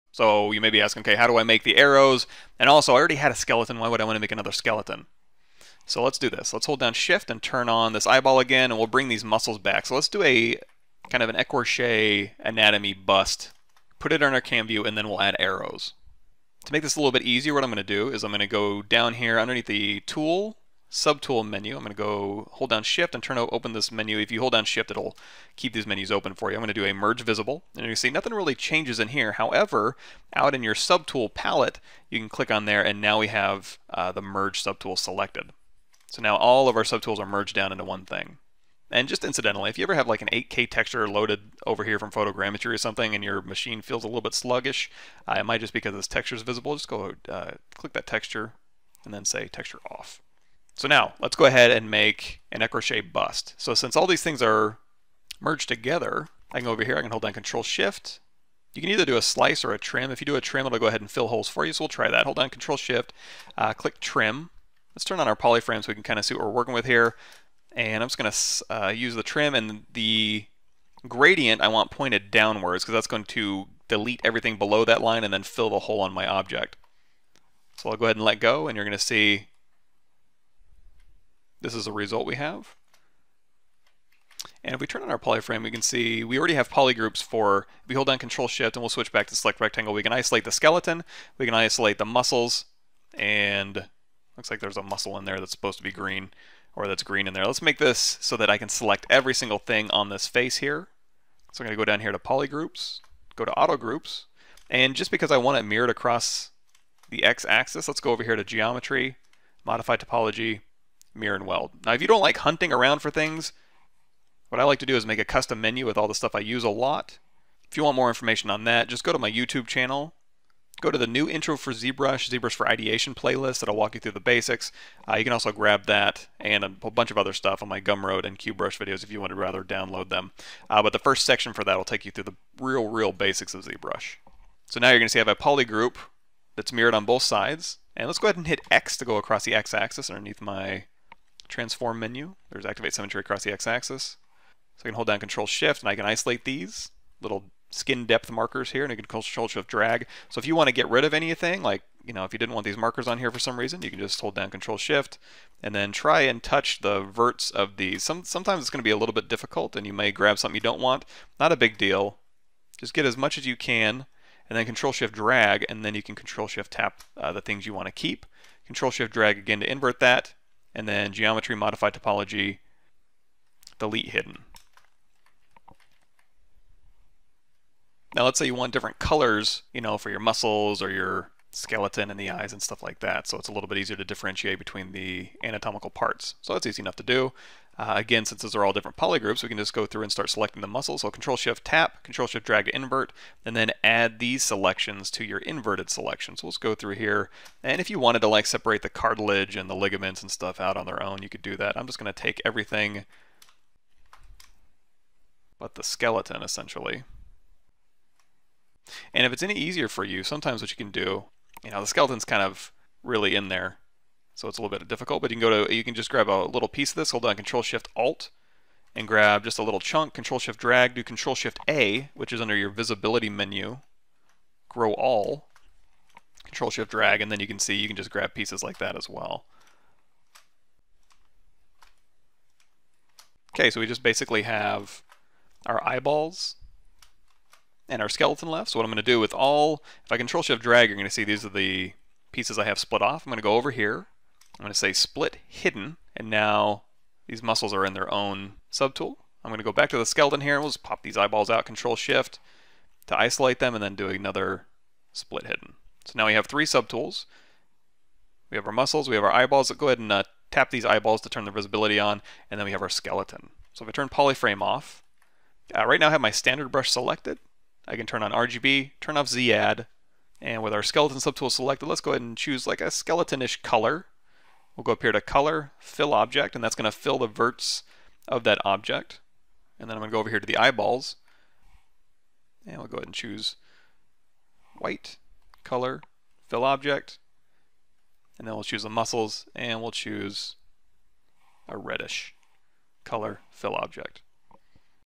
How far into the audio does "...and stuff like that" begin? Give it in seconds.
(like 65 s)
182 s.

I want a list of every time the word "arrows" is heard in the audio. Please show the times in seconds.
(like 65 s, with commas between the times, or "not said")
1 s, 15 s.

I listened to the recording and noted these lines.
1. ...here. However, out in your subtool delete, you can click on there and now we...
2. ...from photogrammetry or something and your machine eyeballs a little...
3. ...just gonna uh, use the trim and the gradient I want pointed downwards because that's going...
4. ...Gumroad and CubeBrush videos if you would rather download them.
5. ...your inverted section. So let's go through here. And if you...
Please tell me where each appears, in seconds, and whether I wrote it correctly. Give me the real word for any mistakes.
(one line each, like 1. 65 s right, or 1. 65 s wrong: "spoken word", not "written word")
1. 29 s wrong: "palette", not "delete"
2. 41 s wrong: "feels", not "eyeballs"
3. 68 s right
4. 127 s right
5. 195 s wrong: "selection", not "section".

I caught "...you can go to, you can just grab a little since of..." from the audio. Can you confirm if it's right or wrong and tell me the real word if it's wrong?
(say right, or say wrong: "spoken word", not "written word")
wrong: "piece", not "since".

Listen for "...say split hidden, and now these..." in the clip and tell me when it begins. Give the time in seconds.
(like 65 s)
244 s.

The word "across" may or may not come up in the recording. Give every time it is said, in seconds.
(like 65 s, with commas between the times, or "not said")
105 s, 139 s, 143 s.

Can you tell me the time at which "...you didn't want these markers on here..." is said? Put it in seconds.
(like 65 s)
152 s.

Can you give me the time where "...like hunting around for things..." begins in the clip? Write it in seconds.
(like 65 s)
112 s.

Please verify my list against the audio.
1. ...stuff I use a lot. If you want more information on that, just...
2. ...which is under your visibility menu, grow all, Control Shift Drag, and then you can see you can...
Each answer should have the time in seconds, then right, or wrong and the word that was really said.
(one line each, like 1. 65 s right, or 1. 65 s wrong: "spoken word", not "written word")
1. 116 s right
2. 222 s right.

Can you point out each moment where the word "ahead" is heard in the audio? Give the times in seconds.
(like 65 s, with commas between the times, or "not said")
51 s, 60 s, 78 s, 138 s, 259 s, 272 s, 282 s.